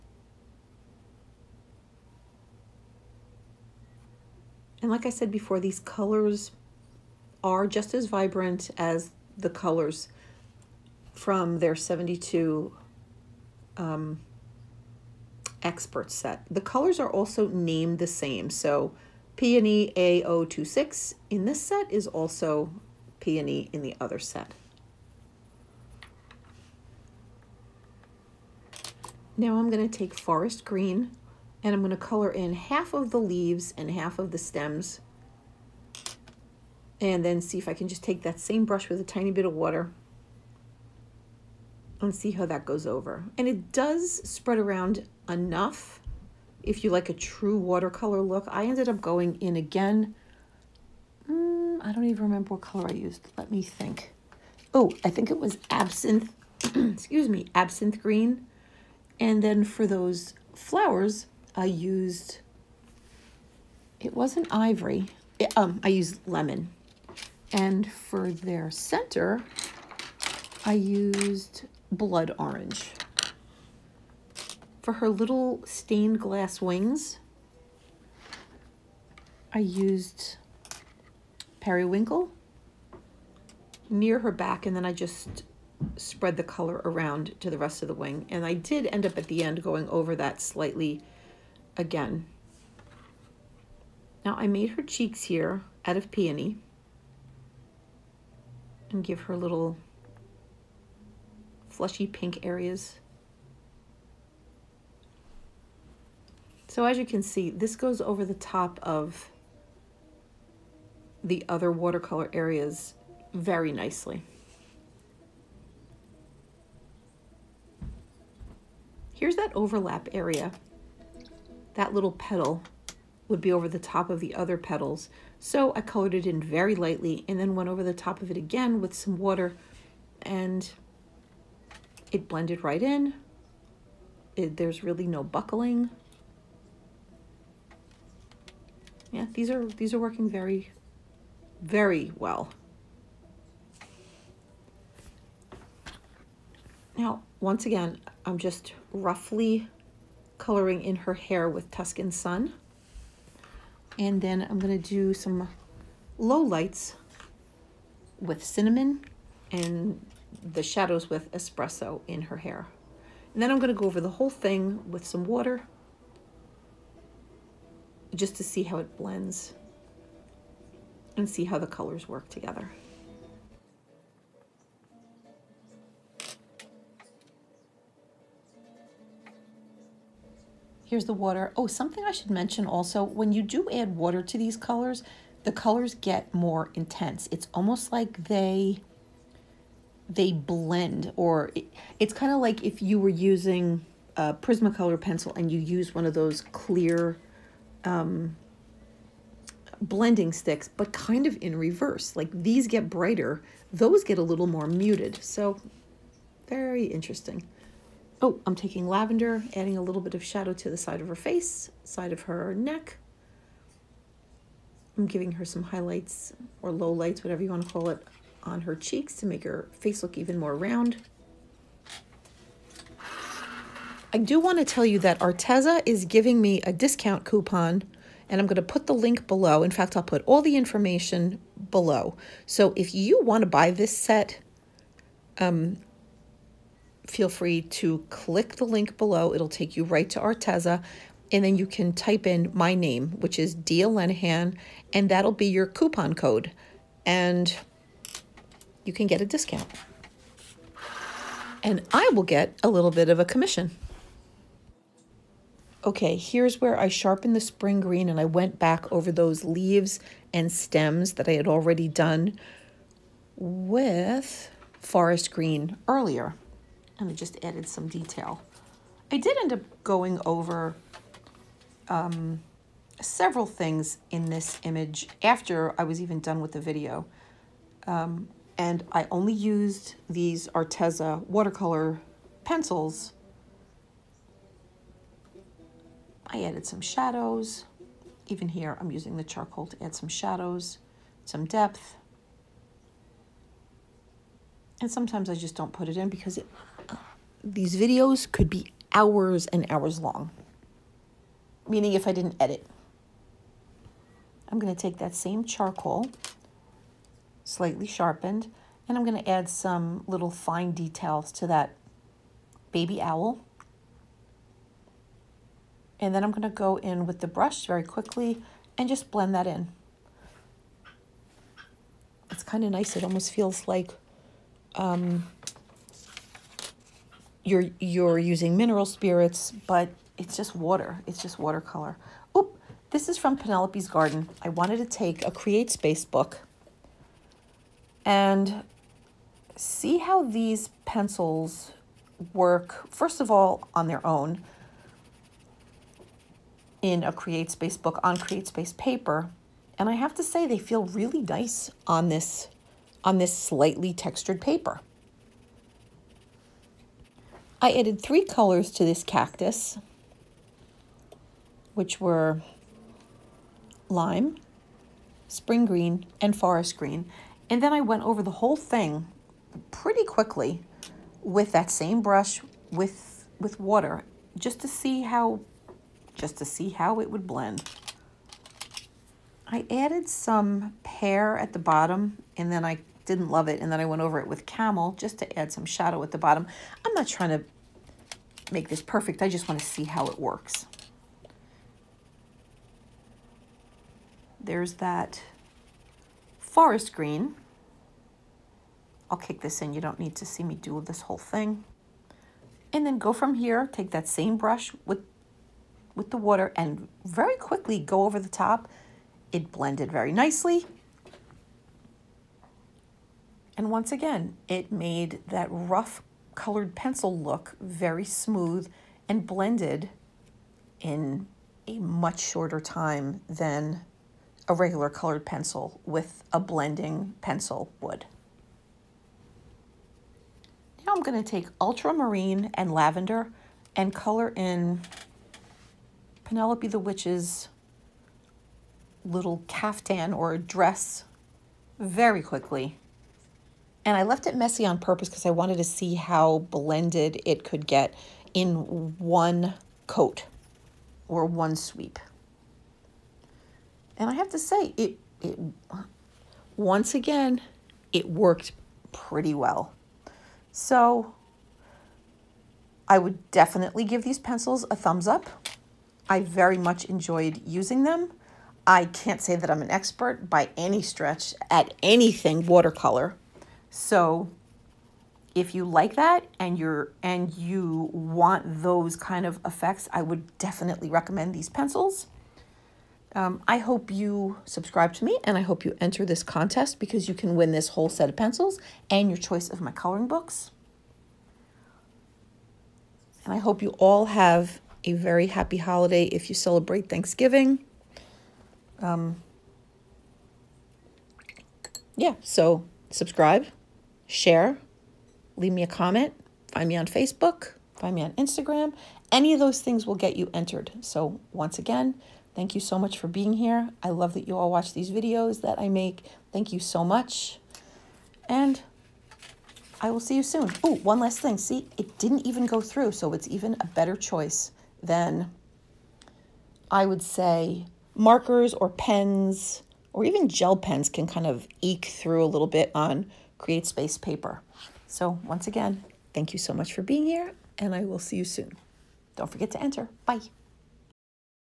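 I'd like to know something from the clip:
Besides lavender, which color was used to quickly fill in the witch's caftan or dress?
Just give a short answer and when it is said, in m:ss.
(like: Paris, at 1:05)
Ultramarine, at 7:11.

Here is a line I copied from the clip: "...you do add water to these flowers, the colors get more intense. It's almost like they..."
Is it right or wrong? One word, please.
wrong.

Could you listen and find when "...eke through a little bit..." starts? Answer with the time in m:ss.
8:51.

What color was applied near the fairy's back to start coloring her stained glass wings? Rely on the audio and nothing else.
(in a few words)
Periwinkle.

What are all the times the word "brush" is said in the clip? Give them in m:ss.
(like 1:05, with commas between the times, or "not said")
0:38, 5:17, 6:12, 6:44.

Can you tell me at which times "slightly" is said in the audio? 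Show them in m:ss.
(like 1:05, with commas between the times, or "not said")
1:30, 5:07, 5:53.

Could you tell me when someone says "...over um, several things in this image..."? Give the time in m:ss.
4:30.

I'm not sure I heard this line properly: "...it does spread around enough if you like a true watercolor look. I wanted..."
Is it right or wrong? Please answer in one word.
wrong.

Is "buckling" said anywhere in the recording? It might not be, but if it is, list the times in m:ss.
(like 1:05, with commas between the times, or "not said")
2:15.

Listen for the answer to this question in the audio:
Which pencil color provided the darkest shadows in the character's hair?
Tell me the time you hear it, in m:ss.
2:41.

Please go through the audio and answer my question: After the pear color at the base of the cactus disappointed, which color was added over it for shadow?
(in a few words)
Camel.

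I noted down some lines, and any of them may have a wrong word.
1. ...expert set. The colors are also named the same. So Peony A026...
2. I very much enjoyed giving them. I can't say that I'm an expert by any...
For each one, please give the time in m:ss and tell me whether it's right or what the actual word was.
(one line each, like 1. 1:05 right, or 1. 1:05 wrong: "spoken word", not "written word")
1. 0:15 right
2. 7:46 wrong: "using", not "giving".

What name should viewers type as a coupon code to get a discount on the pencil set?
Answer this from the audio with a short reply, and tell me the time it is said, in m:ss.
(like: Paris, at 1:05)
Dea Lenihan, at 4:03.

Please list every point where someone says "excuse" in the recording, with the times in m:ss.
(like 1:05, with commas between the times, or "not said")
0:56.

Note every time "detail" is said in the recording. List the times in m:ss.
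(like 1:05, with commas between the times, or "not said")
4:27, 5:10.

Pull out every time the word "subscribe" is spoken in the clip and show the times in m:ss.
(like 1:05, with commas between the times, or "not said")
8:04, 8:22.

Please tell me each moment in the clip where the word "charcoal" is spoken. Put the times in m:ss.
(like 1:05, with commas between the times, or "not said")
4:49, 5:05.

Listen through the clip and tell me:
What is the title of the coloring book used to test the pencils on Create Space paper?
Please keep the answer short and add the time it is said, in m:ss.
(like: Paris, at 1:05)
Penelope's Garden, at 5:33.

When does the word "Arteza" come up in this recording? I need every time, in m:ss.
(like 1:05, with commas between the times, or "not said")
3:45, 4:00, 4:40.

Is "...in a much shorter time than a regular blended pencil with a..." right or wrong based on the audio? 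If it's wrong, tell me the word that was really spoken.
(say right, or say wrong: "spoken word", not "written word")
wrong: "colored", not "blended".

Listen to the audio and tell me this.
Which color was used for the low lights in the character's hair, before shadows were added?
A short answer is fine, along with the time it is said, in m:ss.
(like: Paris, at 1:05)
Cinnamon, at 2:38.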